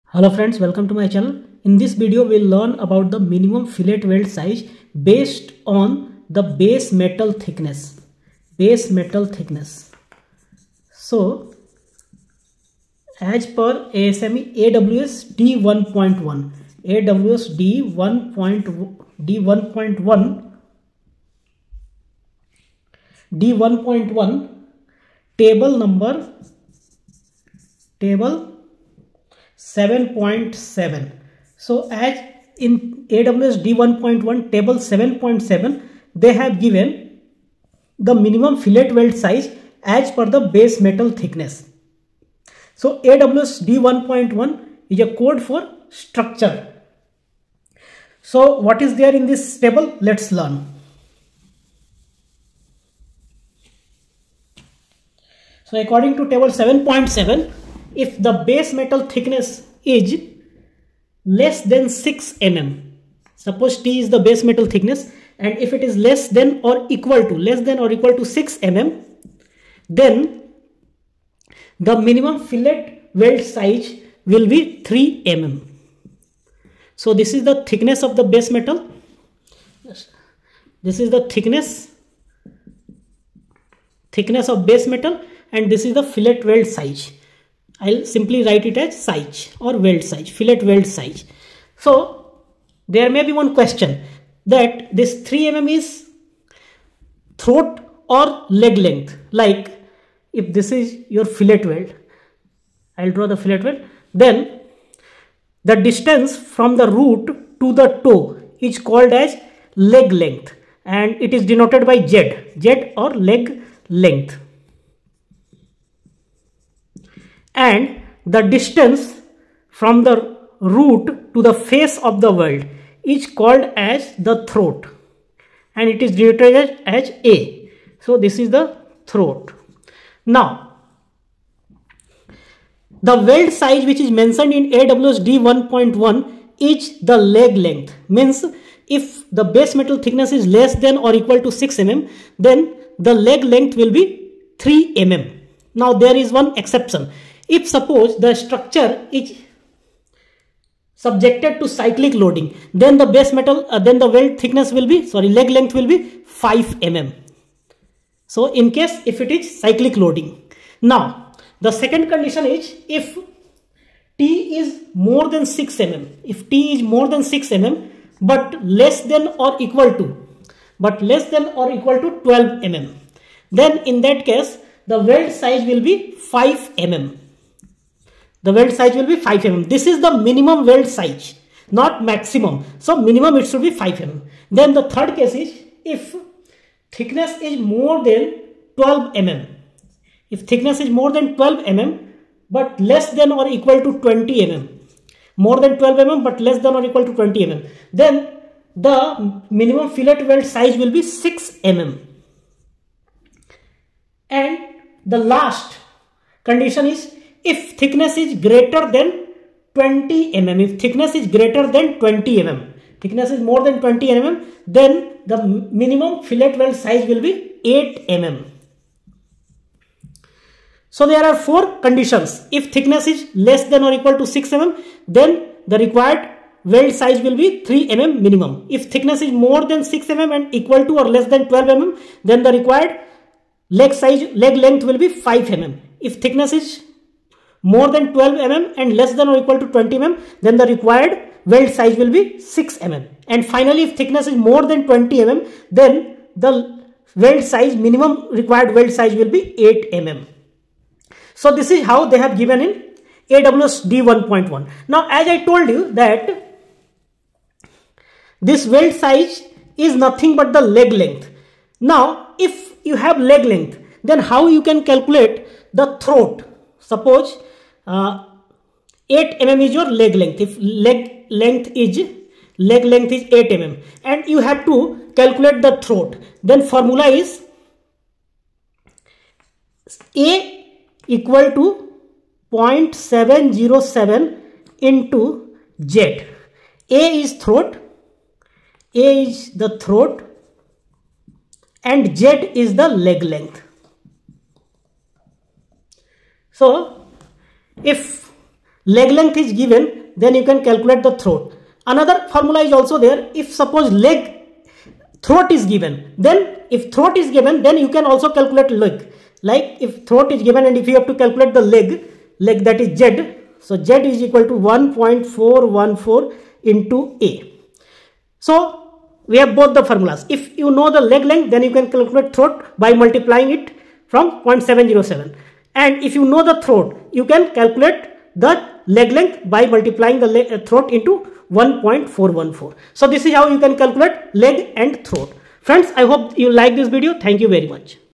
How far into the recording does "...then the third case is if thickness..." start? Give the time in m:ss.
3:04.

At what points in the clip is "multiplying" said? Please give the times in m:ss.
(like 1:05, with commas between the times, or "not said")
5:22, 5:29.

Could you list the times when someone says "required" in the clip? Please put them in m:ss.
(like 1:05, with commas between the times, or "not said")
3:45, 3:52, 4:00, 4:08.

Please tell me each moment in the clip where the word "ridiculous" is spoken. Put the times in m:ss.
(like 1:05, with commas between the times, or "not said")
not said.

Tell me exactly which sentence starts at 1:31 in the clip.
So there may be one question that this 3 mm is throat or leg length.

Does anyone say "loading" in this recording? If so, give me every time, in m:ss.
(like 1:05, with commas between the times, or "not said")
2:32, 2:39.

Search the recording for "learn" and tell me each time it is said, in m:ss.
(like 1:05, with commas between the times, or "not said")
0:02, 0:50.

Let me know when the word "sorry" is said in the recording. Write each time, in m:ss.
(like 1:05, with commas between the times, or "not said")
2:35.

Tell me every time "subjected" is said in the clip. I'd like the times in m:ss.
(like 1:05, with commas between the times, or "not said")
2:30.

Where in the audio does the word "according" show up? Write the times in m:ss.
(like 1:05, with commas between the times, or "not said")
0:55.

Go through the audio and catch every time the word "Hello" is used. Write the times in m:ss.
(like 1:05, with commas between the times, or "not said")
0:00.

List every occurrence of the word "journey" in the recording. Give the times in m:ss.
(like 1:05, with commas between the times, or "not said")
not said.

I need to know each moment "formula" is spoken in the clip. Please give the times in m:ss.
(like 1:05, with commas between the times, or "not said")
4:36, 5:02, 5:19.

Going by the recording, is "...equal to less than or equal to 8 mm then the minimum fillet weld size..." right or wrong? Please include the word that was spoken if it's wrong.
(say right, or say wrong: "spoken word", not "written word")
wrong: "6", not "8".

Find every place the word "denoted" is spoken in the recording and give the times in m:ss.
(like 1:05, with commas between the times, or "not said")
1:51, 2:06.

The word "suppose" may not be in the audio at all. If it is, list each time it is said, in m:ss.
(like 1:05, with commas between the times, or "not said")
1:03, 2:27, 4:26, 5:03.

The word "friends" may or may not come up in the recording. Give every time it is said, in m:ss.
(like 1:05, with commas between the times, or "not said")
0:00, 5:35.